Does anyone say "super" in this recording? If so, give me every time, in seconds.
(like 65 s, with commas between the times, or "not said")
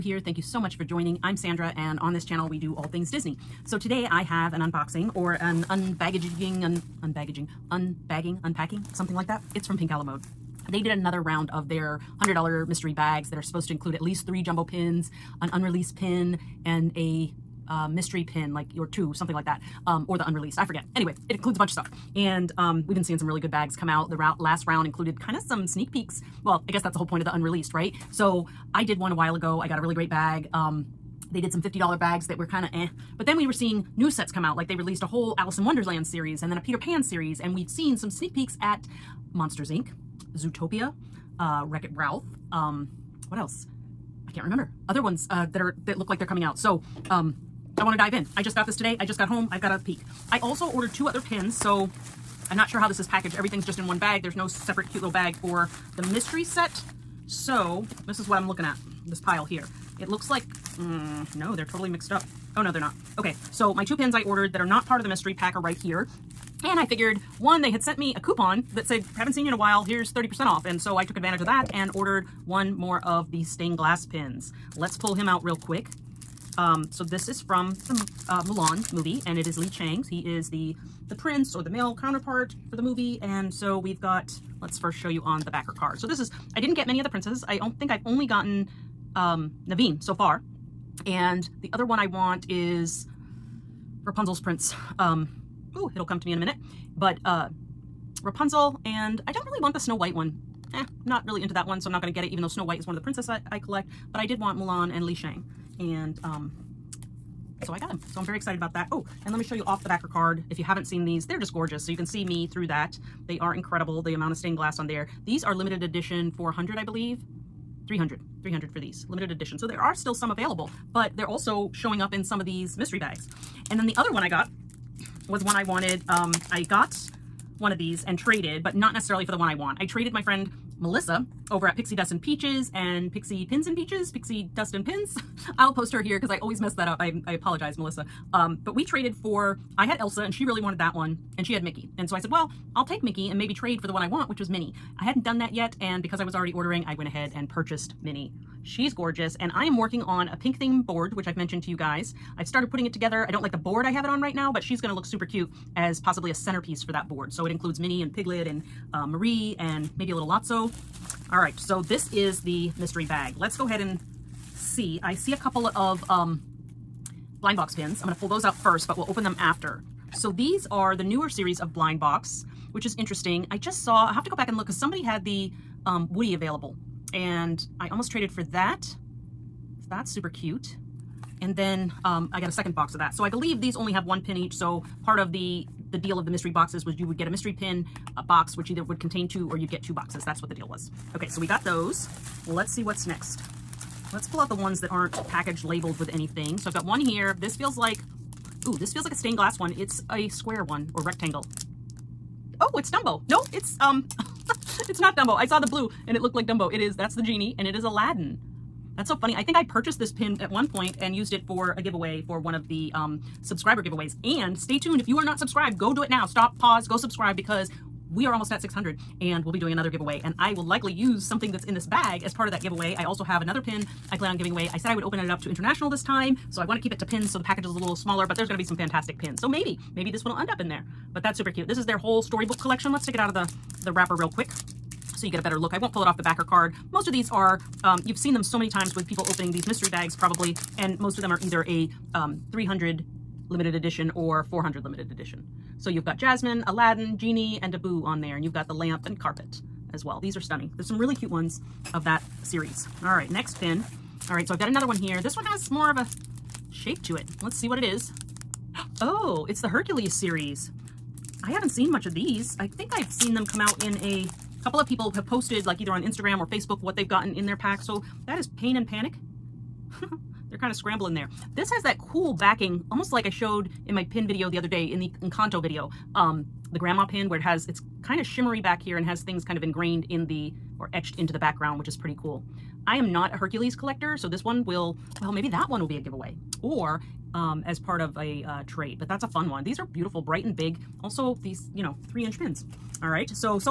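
155 s, 180 s, 231 s.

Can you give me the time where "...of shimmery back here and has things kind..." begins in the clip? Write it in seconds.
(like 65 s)
278 s.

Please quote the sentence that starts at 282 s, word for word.
I am not a Hercules collector, so this one will, well, maybe that one will be a giveaway.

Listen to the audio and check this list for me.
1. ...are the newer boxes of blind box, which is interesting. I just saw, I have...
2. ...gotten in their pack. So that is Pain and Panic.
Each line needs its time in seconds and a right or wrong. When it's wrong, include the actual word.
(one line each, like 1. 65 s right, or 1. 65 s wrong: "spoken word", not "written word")
1. 170 s wrong: "series", not "boxes"
2. 267 s right.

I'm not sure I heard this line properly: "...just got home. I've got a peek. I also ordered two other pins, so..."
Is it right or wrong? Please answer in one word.
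right.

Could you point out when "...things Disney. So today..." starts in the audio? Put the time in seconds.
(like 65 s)
2 s.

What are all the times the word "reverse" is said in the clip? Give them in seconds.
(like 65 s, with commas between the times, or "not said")
not said.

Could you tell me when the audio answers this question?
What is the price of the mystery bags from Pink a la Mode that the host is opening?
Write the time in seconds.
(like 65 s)
12 s.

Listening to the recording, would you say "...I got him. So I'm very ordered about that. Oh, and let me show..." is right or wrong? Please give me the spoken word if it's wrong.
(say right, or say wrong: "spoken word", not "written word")
wrong: "excited", not "ordered".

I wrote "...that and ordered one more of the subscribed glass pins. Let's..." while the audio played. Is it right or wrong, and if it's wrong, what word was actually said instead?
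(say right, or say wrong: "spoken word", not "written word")
wrong: "stained", not "subscribed".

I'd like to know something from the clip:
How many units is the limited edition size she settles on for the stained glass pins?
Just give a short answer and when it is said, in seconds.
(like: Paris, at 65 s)
300, at 118 s.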